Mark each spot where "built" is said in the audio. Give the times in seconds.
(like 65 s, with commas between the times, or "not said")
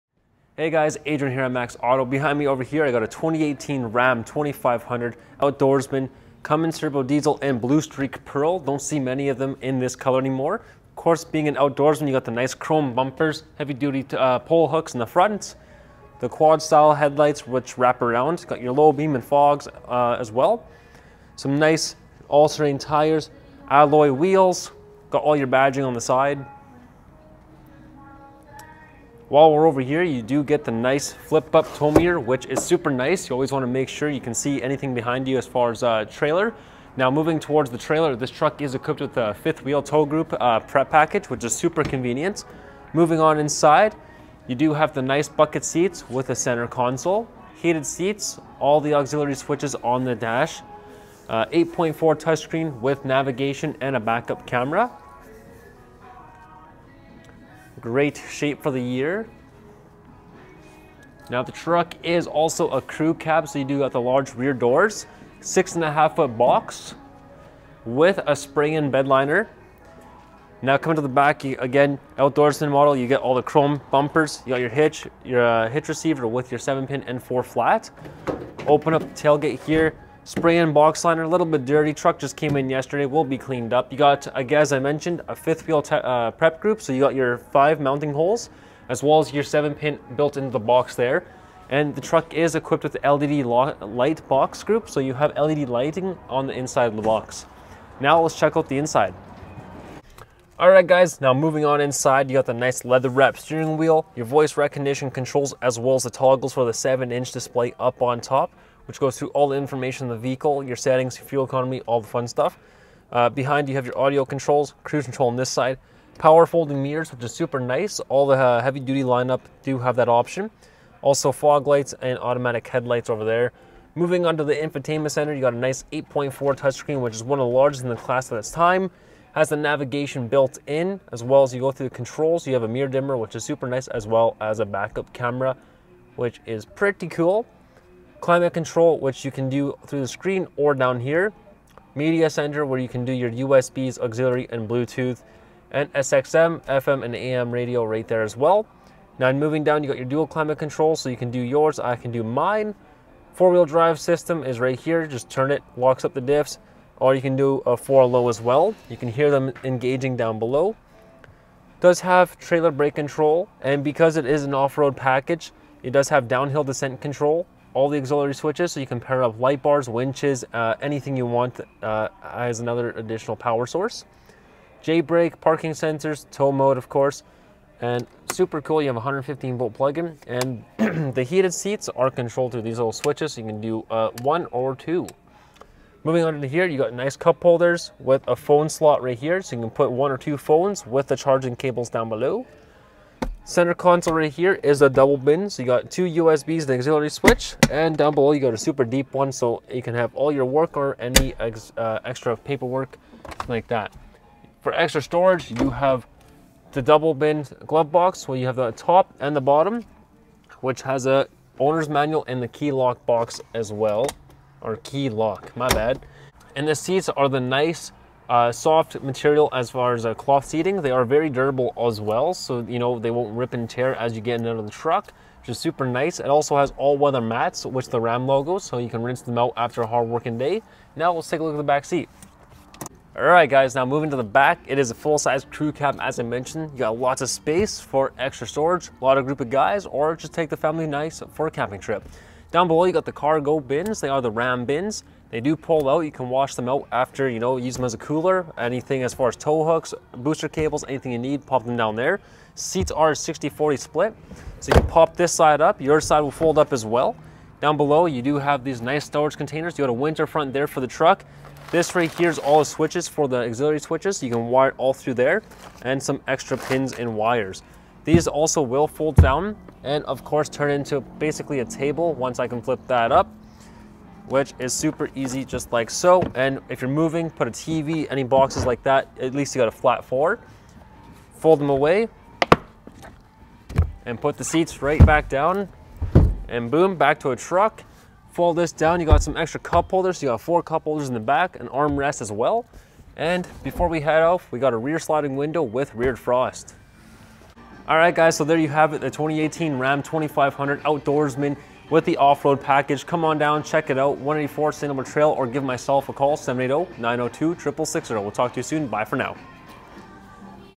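90 s, 130 s.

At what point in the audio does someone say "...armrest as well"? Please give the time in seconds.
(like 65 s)
291 s.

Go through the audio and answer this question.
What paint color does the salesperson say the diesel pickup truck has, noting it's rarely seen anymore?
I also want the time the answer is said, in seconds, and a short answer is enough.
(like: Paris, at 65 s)
Blue Streak Pearl, at 7 s.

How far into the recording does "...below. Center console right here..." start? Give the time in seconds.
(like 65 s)
192 s.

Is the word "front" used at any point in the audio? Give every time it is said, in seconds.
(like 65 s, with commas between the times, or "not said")
15 s, 260 s.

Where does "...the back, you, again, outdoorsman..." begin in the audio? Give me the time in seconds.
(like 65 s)
71 s.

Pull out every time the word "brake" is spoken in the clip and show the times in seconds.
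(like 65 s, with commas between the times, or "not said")
162 s, 174 s.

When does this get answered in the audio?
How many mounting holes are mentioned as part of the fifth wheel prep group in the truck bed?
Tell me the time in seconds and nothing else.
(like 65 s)
87 s.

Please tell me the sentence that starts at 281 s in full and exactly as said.
Fold them away and put the seats right back down and boom, back to a truck.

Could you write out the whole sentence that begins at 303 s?
Come on down, check it out, 184 St.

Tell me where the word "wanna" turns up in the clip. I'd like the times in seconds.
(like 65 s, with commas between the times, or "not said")
33 s.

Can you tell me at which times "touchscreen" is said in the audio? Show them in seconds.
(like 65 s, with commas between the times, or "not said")
52 s, 126 s.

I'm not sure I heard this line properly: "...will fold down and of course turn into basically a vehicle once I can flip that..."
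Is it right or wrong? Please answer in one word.
wrong.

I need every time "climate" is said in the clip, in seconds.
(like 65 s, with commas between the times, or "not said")
138 s, 150 s.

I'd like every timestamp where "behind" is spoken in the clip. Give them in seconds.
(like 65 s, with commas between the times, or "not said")
2 s, 34 s, 113 s.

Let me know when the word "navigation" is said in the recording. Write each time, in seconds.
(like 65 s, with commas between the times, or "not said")
53 s, 129 s.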